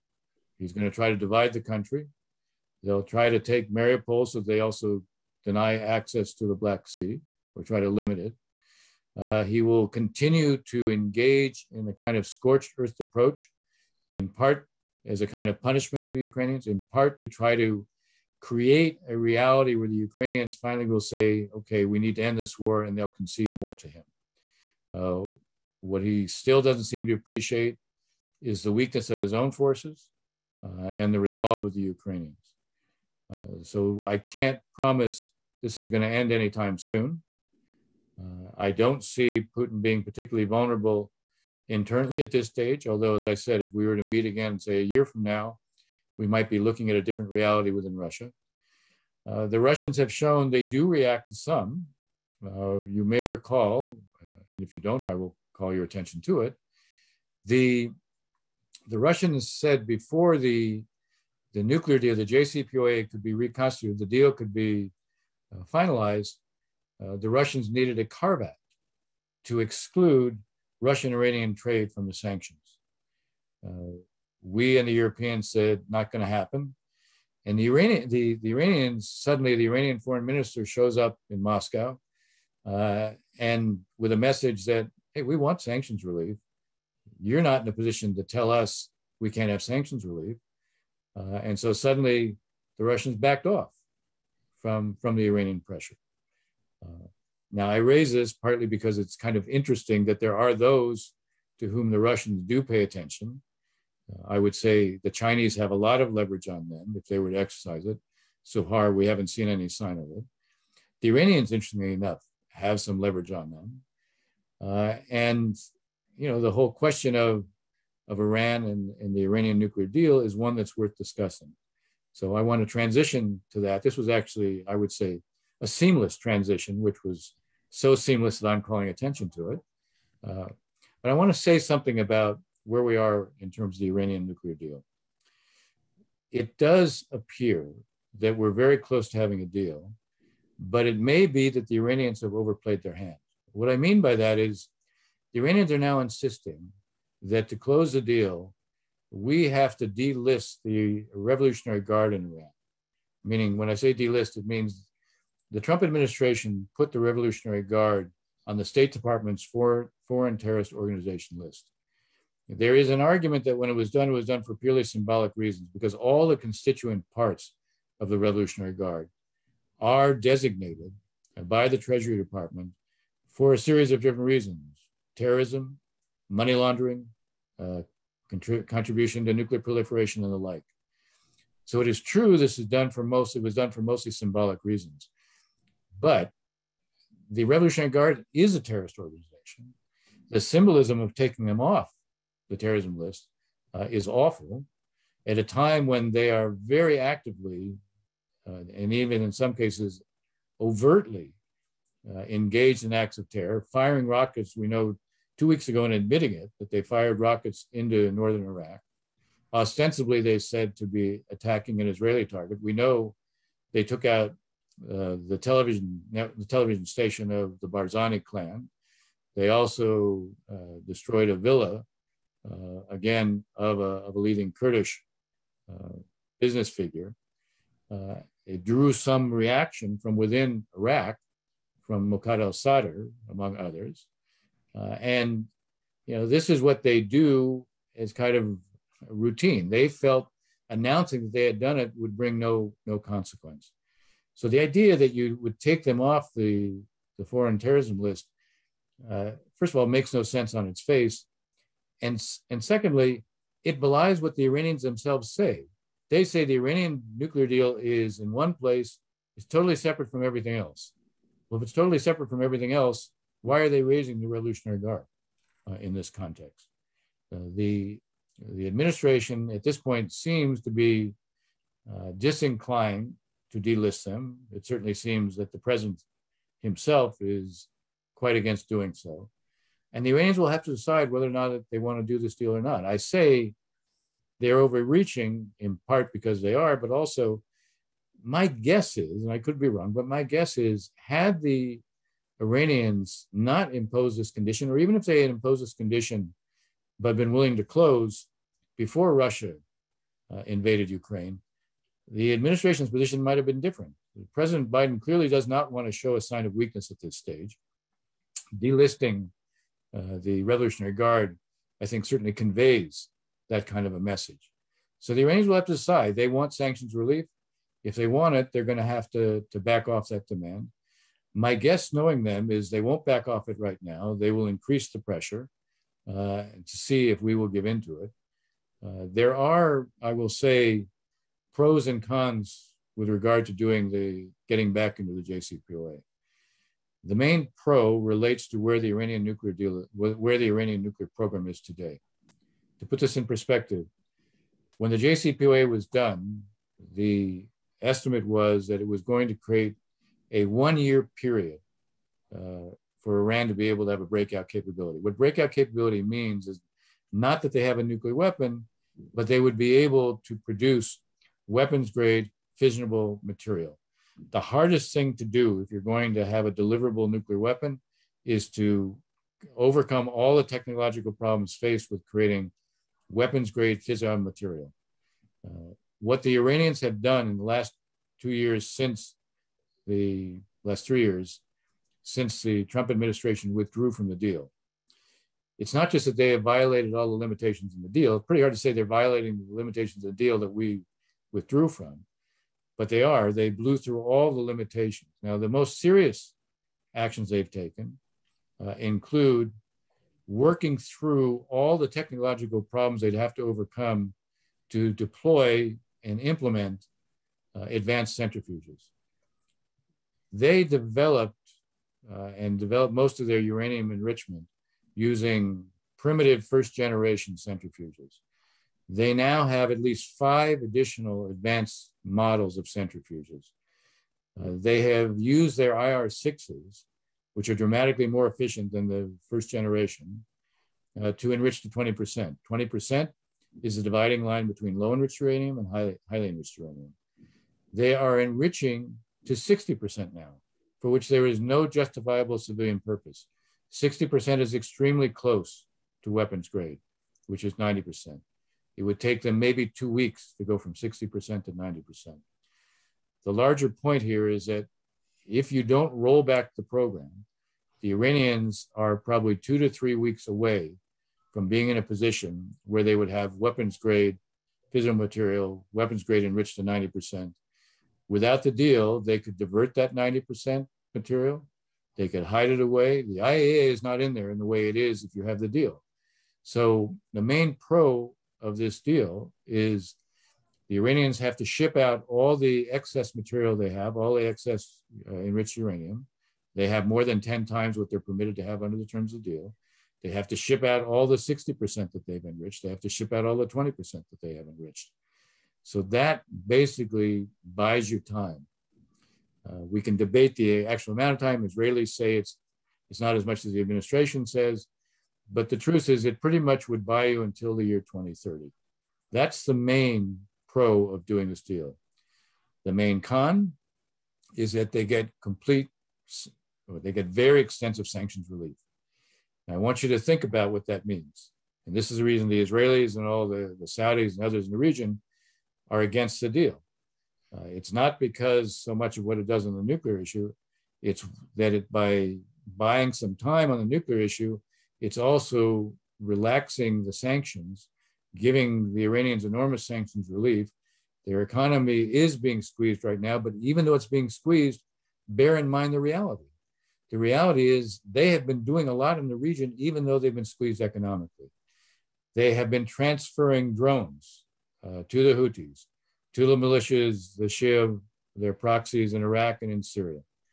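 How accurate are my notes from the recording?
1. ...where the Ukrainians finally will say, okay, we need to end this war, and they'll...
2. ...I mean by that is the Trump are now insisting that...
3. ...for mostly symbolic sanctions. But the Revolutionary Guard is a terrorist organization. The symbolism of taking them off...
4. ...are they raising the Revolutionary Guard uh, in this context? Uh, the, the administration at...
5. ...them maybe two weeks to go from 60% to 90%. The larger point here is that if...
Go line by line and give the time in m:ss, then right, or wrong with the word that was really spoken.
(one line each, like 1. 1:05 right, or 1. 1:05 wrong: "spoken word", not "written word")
1. 0:19 right
2. 2:23 wrong: "Iranians", not "Trump"
3. 3:03 wrong: "reasons", not "sanctions"
4. 4:23 right
5. 7:29 right.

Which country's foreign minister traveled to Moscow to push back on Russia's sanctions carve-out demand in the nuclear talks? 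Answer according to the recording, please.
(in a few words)
Iranian foreign minister.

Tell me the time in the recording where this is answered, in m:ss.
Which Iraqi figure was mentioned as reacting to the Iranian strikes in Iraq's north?
3:52.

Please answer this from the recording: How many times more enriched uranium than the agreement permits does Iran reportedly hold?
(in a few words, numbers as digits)
10 times.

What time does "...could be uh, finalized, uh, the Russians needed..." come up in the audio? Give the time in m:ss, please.
1:04.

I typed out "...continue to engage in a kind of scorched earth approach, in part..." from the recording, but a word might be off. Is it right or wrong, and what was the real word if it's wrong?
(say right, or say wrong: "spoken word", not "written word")
right.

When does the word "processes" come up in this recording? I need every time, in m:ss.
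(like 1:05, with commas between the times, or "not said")
not said.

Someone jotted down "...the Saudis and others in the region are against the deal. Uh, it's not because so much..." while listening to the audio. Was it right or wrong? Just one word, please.
right.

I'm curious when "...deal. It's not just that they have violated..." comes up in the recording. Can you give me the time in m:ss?
6:24.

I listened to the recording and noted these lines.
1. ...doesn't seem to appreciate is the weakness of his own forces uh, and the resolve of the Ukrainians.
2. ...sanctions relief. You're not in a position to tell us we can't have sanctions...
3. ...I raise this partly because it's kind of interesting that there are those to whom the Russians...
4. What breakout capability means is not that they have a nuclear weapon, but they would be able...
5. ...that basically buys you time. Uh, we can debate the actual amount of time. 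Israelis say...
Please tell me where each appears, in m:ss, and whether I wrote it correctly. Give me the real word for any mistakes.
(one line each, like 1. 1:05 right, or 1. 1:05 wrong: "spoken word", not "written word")
1. 0:26 right
2. 1:25 right
3. 1:37 right
4. 5:54 right
5. 8:15 right.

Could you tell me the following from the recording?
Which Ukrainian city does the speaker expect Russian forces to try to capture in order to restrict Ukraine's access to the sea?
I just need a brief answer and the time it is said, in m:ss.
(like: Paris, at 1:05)
Mariupol, at 0:03.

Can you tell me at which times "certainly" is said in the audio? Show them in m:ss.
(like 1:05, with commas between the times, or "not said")
4:34, 5:12.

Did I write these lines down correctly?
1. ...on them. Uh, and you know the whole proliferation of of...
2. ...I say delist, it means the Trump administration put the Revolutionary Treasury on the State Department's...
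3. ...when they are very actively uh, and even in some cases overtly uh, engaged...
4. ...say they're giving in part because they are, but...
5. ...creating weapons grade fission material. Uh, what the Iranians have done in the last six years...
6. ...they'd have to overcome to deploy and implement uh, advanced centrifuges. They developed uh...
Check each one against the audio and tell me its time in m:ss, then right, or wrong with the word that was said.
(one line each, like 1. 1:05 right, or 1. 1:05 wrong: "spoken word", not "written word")
1. 1:53 wrong: "question", not "proliferation"
2. 2:33 wrong: "Guard", not "Treasury"
3. 3:15 right
4. 4:42 wrong: "overreaching", not "giving"
5. 6:12 wrong: "two", not "six"
6. 6:43 right.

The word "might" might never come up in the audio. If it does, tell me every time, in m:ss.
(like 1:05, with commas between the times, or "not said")
0:46, 5:03.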